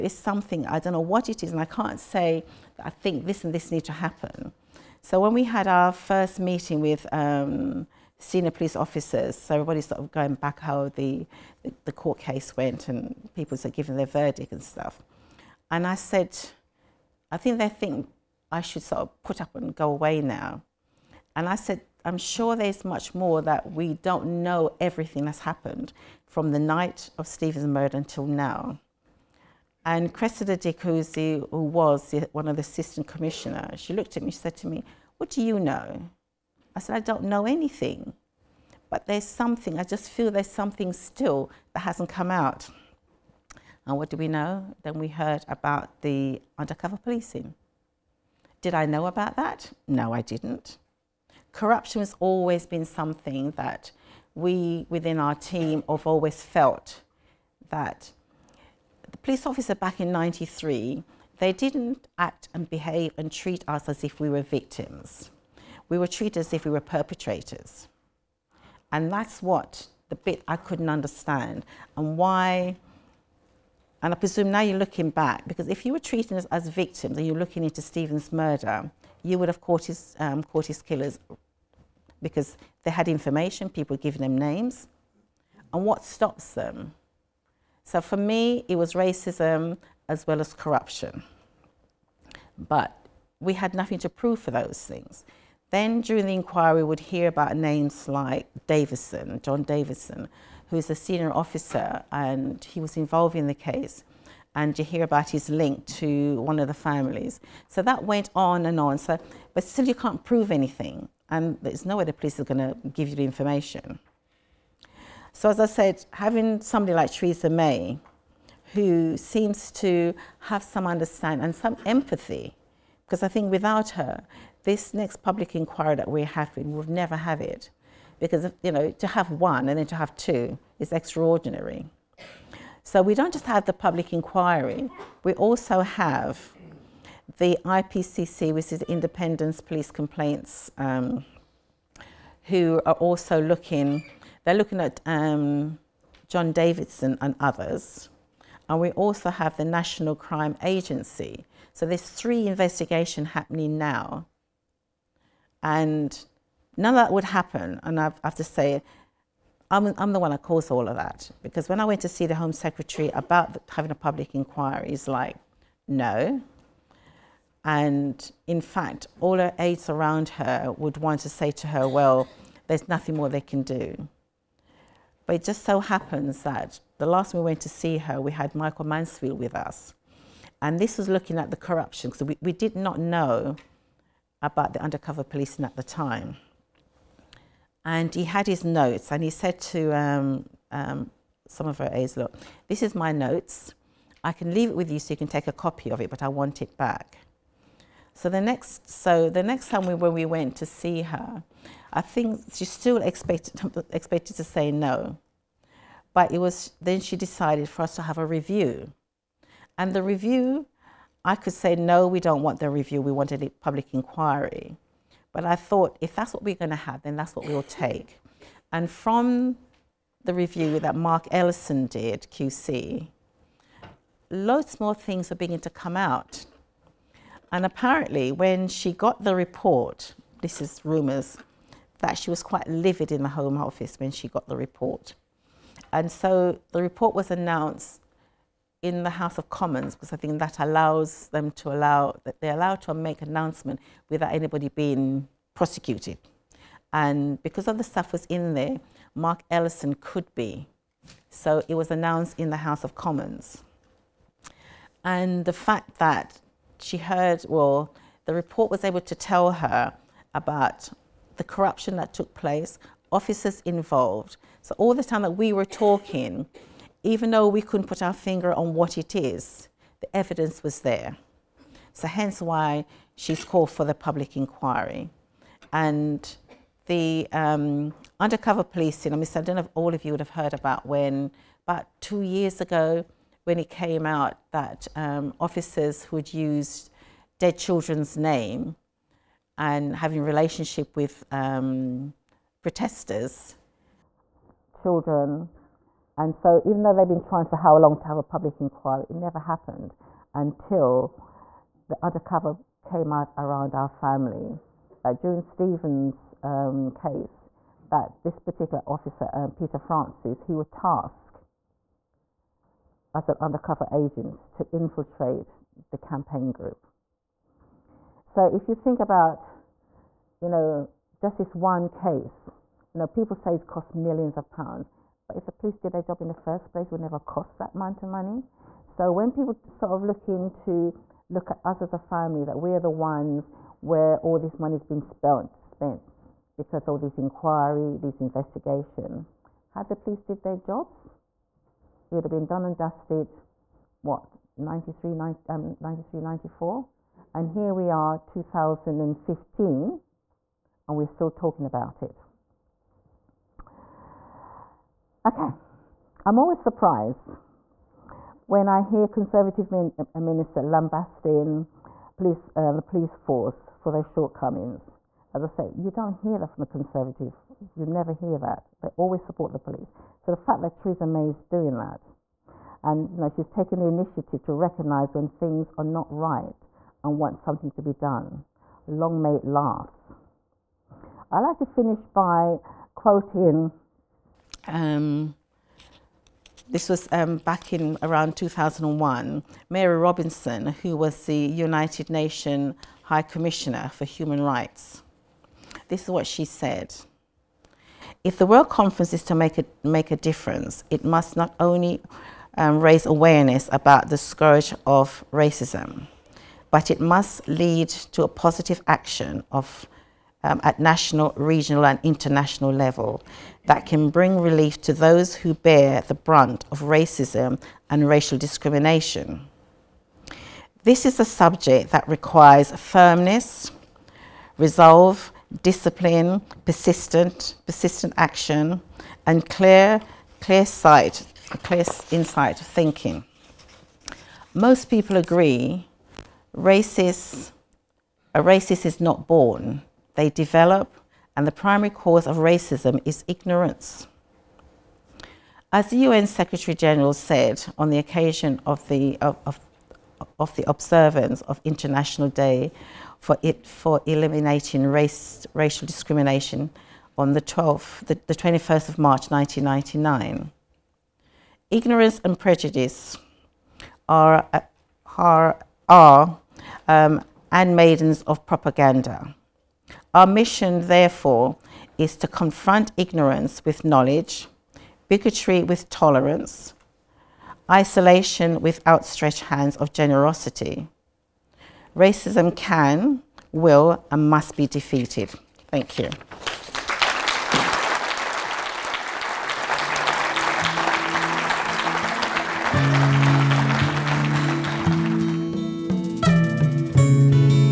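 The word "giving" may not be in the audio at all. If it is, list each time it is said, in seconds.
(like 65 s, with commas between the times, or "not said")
13 s, 83 s.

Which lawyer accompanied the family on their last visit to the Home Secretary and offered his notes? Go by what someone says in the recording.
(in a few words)
Michael Mansfield.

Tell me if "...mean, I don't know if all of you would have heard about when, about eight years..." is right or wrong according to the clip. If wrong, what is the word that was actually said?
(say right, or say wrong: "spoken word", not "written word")
wrong: "two", not "eight".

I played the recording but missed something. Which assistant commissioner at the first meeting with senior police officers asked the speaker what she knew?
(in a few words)
Cressida DeCozy.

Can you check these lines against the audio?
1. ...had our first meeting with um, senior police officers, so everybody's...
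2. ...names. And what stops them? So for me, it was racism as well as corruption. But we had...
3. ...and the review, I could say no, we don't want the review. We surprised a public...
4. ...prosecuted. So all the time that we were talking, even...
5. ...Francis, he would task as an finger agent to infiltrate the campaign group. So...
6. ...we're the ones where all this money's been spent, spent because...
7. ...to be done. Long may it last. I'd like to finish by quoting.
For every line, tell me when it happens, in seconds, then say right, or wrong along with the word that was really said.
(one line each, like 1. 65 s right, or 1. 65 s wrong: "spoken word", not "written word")
1. 5 s right
2. 84 s right
3. 209 s wrong: "wanted", not "surprised"
4. 263 s wrong: "involved", not "prosecuted"
5. 309 s wrong: "undercover", not "finger"
6. 332 s right
7. 377 s right.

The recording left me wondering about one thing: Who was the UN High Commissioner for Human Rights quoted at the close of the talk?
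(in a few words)
Mary Robinson.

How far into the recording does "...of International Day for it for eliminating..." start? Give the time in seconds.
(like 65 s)
451 s.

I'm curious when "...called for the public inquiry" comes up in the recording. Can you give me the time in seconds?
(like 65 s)
273 s.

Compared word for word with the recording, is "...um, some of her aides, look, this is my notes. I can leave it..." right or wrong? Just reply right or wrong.
right.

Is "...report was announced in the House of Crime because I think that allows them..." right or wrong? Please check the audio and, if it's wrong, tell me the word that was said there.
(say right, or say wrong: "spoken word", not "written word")
wrong: "Commons", not "Crime".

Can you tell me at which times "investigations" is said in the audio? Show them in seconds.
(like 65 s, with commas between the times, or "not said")
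152 s, 338 s.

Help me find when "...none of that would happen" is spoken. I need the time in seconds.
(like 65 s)
156 s.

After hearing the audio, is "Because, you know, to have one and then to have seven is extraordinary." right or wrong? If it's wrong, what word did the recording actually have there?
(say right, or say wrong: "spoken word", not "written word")
wrong: "two", not "seven".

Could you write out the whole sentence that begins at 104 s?
And you hear about his link to one of the families.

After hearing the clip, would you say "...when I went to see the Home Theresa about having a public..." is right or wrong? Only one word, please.
wrong.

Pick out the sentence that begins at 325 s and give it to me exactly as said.
But if the police did their job in the first place, it would never cost that amount of money.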